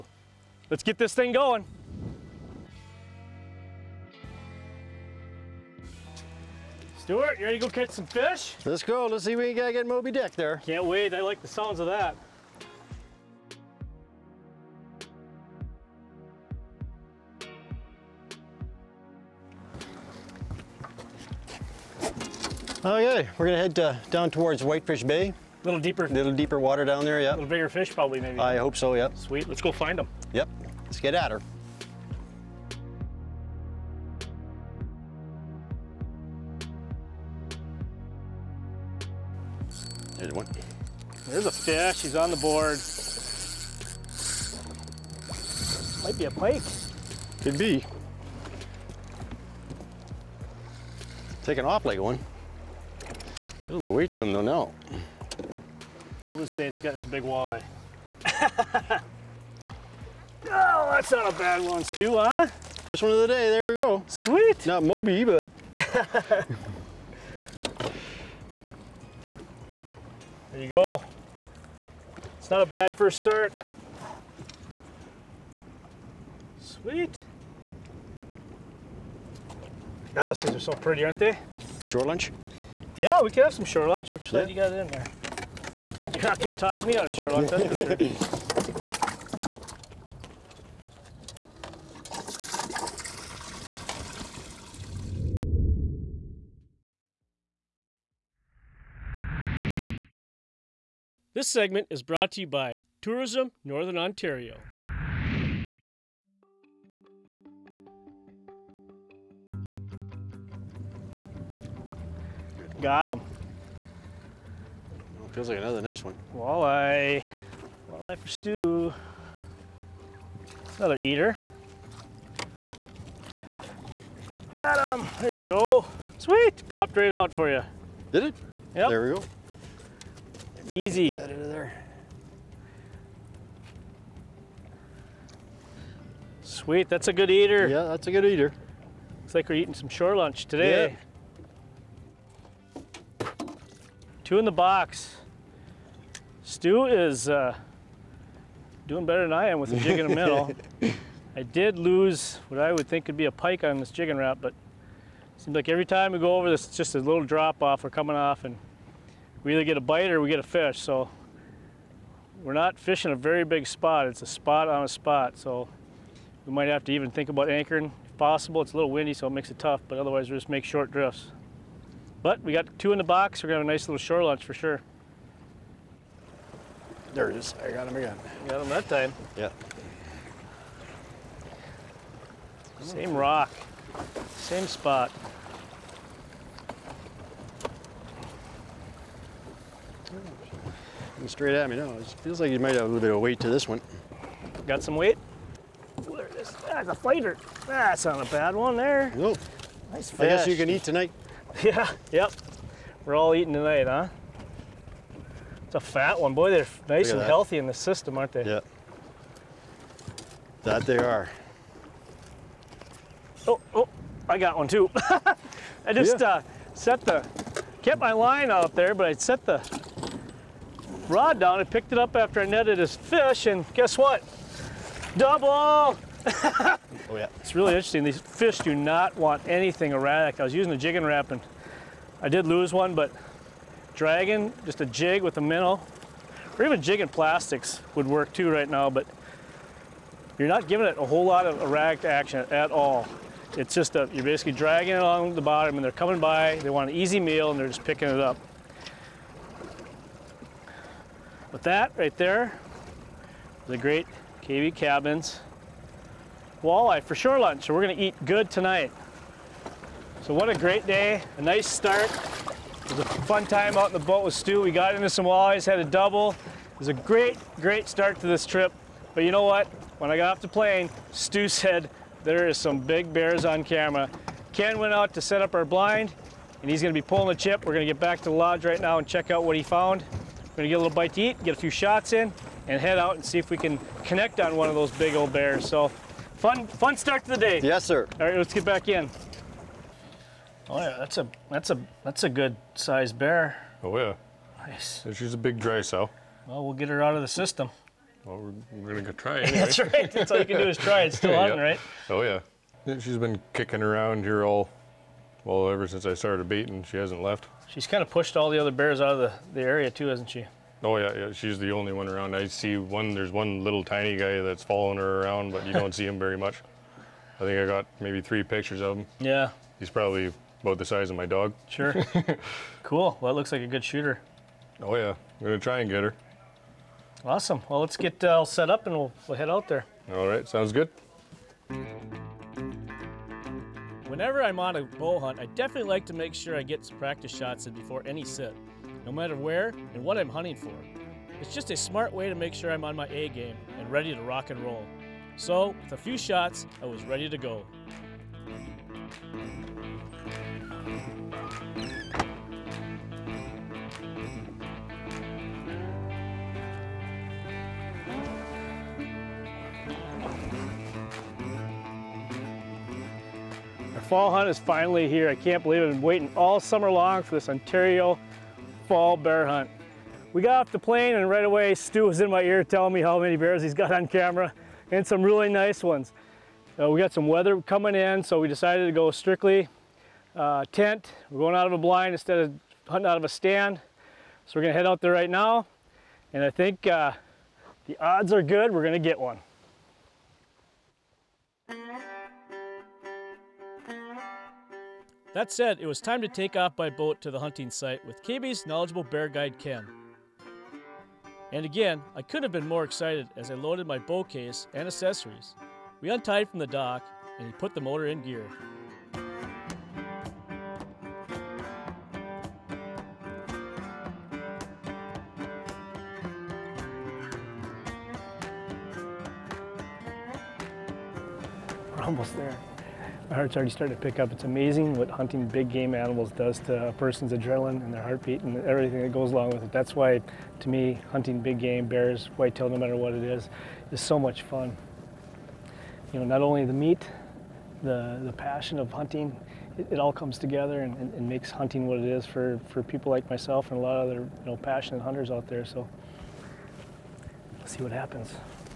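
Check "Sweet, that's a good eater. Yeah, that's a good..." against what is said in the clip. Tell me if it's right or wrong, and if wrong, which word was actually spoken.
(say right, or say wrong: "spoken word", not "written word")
right.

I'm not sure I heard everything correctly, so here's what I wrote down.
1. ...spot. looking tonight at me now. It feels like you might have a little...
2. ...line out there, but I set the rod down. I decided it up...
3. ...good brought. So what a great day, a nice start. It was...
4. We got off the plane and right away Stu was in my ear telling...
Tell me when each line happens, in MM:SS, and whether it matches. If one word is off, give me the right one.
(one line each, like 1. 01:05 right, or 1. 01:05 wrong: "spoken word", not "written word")
1. 03:04 wrong: "straight", not "tonight"
2. 03:38 wrong: "picked", not "decided"
3. 04:18 wrong: "tonight", not "brought"
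4. 06:10 right.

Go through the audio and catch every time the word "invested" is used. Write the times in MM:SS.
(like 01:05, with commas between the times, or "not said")
not said.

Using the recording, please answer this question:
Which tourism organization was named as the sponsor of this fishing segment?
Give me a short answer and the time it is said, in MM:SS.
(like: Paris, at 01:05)
Tourism Northern Ontario, at 01:43.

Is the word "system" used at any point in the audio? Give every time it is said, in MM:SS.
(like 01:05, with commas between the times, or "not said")
03:27, 04:57.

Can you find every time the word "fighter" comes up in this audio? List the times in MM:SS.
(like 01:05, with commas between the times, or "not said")
03:16.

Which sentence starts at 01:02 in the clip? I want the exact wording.
First one of the day, there we go.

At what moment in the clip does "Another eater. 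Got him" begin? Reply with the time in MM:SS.
02:00.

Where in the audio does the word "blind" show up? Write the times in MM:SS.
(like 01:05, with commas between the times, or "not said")
04:35, 06:21.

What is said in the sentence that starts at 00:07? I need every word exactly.
Stuart, you ready to go catch some fish?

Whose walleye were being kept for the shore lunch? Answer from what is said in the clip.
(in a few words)
Kaby Kabins.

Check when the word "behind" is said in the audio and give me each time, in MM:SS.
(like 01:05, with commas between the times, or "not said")
not said.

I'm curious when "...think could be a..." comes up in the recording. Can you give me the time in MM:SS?
02:32.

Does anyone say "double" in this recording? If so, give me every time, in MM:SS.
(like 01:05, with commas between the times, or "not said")
03:45, 04:25.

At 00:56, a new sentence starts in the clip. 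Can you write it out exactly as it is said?
Let's say it's got its big walleye.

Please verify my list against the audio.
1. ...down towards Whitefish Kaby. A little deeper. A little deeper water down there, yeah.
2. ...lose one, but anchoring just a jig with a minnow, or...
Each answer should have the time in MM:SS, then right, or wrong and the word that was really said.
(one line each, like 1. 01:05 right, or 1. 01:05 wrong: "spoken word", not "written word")
1. 00:24 wrong: "Bay", not "Kaby"
2. 03:52 wrong: "dragging", not "anchoring".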